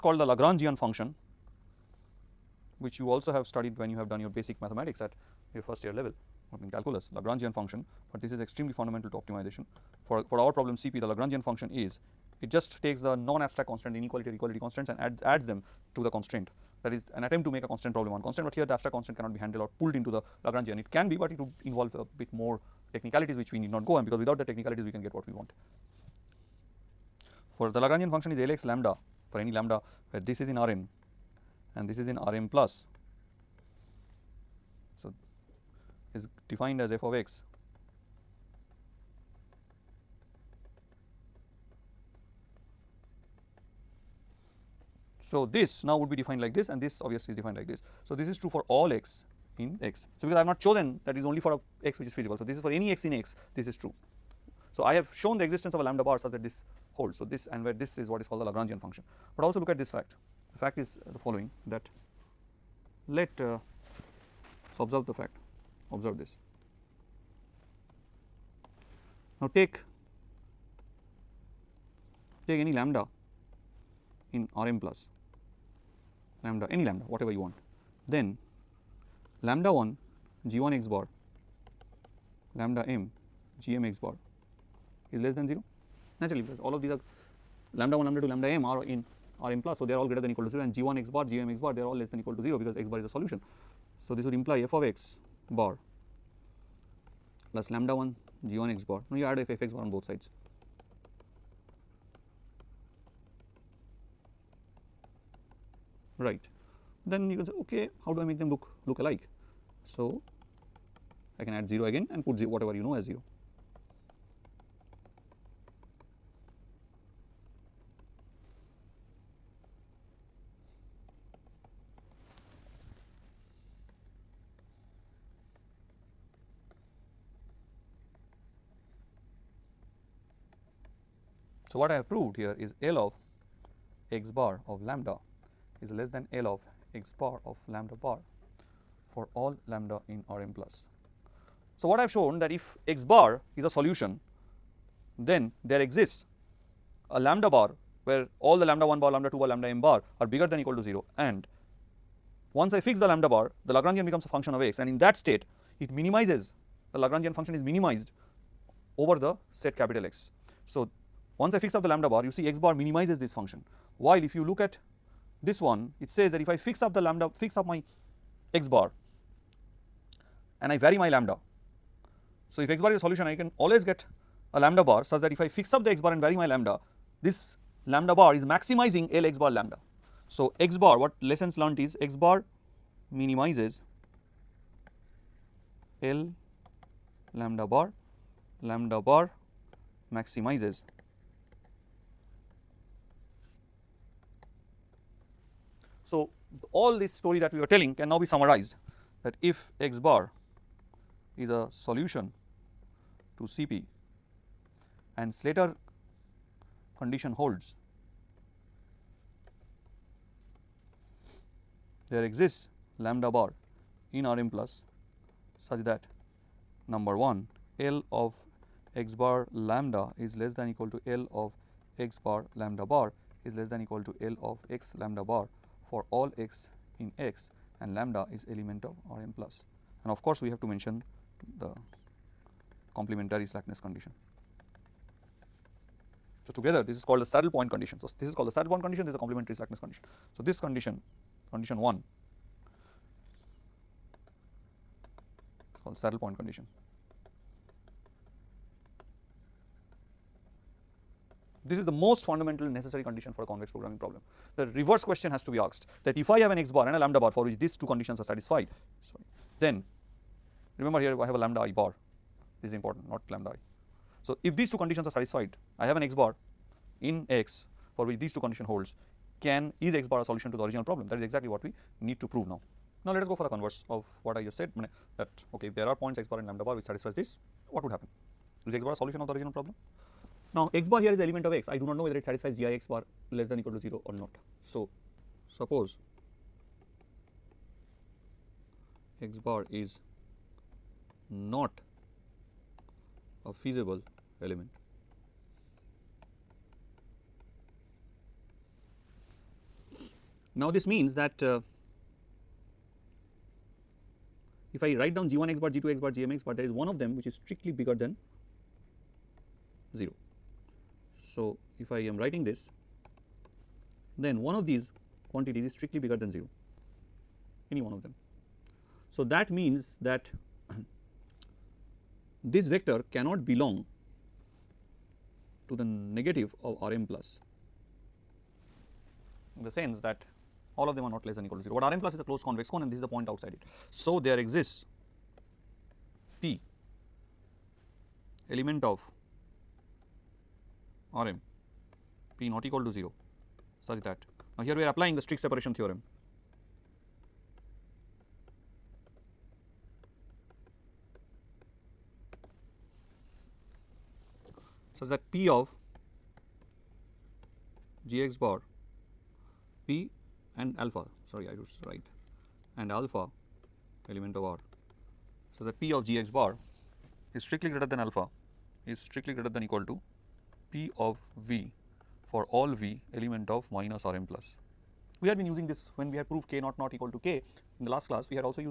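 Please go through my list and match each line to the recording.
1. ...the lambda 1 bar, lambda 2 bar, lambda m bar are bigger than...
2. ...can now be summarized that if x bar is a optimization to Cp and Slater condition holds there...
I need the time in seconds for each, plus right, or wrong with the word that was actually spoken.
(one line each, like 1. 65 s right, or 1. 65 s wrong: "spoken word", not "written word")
1. 148 s right
2. 197 s wrong: "solution", not "optimization".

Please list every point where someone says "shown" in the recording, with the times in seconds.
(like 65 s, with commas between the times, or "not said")
55 s, 142 s.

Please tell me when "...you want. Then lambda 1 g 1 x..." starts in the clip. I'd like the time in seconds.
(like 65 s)
77 s.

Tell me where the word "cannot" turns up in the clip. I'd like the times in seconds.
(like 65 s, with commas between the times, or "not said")
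19 s, 323 s.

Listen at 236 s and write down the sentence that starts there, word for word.
So, together this is called the saddle point condition.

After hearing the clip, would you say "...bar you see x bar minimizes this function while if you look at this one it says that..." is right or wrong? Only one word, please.
right.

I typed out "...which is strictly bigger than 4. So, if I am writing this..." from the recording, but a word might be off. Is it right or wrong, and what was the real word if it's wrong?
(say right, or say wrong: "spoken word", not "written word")
wrong: "0", not "4".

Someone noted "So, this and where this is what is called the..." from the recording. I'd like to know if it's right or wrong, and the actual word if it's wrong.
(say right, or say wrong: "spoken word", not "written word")
right.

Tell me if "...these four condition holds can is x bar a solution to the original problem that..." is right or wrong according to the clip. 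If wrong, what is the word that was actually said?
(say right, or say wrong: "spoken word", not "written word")
wrong: "two", not "four".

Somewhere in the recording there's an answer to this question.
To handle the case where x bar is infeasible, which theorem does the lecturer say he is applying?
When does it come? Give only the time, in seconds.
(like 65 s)
345 s.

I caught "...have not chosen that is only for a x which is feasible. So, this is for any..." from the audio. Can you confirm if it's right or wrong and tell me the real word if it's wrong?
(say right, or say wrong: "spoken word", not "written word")
right.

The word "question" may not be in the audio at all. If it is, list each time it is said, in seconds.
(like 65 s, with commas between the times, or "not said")
255 s.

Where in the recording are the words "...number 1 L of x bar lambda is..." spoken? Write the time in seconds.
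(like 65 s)
216 s.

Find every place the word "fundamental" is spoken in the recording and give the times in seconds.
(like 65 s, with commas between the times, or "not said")
8 s, 252 s.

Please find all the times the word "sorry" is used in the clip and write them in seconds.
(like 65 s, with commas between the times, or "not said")
259 s, 361 s.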